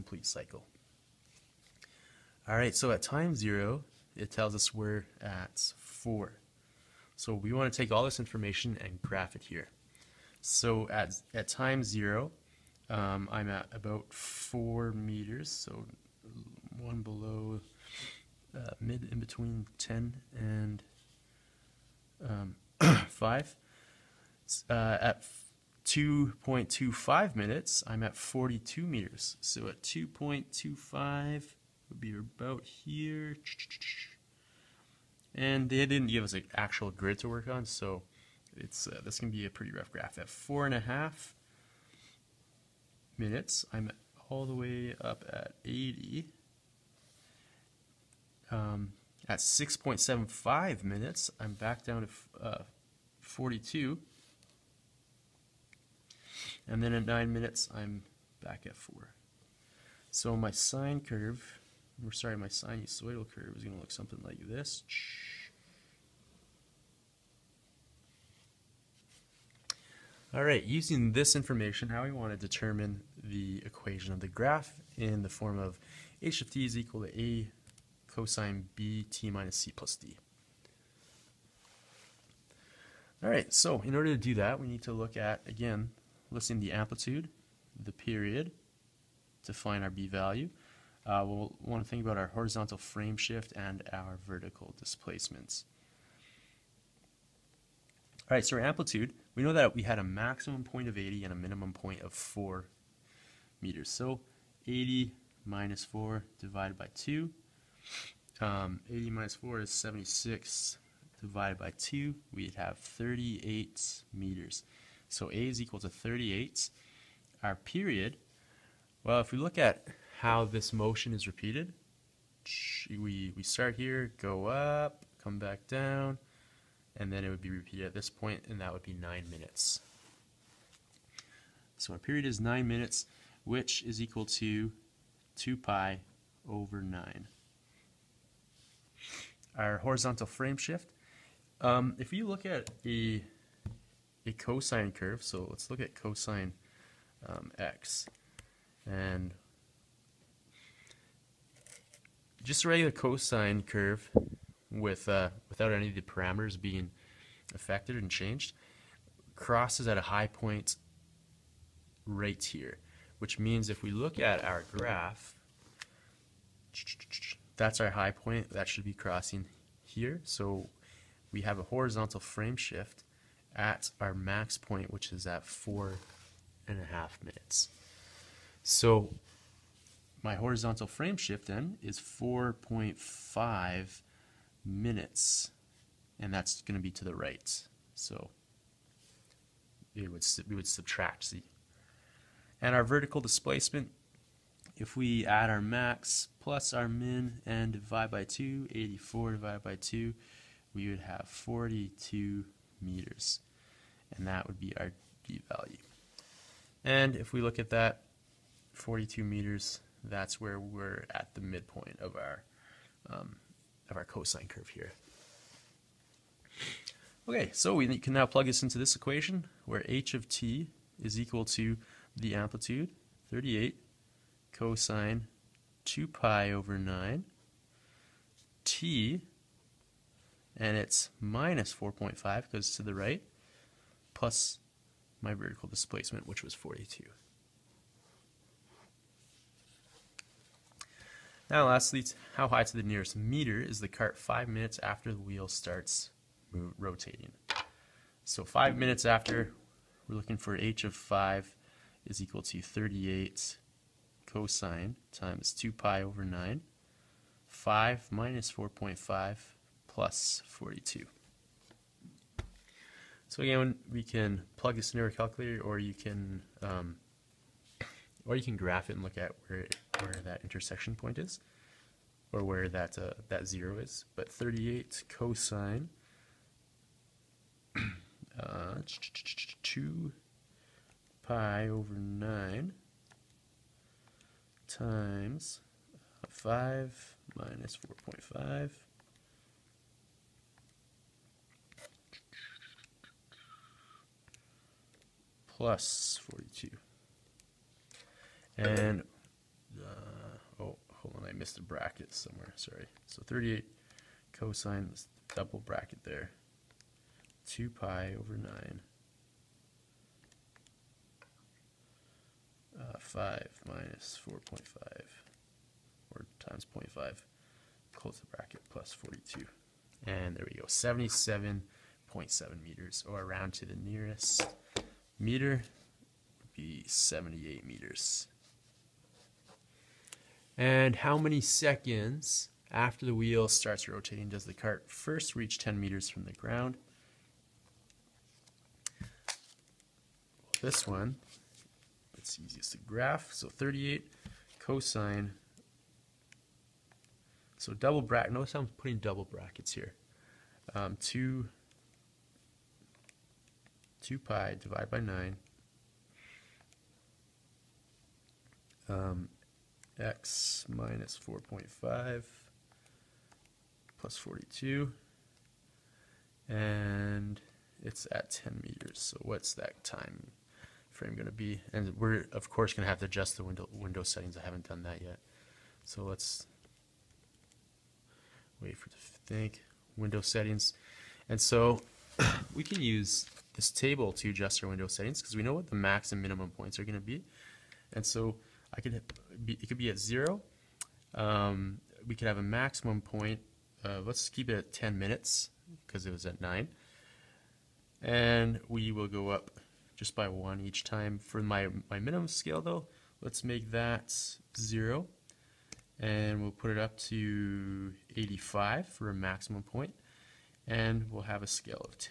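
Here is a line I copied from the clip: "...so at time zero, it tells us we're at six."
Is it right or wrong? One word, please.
wrong.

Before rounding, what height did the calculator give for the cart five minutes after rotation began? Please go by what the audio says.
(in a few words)
77.7 meters.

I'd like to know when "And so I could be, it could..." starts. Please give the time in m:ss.
6:27.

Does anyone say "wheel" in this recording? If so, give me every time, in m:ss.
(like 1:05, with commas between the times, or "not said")
4:05, 5:33.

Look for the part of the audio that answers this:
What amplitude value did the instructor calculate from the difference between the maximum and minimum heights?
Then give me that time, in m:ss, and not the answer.
1:52.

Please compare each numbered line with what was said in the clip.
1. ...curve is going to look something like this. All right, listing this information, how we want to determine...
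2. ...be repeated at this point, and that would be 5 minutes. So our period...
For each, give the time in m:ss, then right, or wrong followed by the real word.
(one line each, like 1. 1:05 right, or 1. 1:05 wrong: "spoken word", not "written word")
1. 1:03 wrong: "using", not "listing"
2. 2:07 wrong: "9", not "5".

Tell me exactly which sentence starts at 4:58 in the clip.
And, uh, oh, hold on, I missed a bracket somewhere, sorry.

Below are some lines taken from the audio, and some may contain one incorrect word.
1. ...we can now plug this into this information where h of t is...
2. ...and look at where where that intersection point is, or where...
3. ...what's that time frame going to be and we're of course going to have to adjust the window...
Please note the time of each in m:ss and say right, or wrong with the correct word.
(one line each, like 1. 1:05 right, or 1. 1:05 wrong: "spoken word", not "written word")
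1. 3:37 wrong: "equation", not "information"
2. 4:28 right
3. 6:09 right.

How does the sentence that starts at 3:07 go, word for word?
So it would, we would subtract Z.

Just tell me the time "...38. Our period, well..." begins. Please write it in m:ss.
1:55.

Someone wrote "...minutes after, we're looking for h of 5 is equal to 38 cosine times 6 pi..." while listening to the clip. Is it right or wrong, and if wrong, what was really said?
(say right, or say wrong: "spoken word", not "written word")
wrong: "2", not "6".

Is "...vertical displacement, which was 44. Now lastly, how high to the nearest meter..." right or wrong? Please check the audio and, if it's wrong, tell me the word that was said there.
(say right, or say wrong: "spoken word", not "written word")
wrong: "42", not "44".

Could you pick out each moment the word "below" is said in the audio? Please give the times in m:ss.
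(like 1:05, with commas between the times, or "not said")
0:17.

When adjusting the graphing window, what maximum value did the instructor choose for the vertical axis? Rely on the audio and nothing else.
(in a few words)
85.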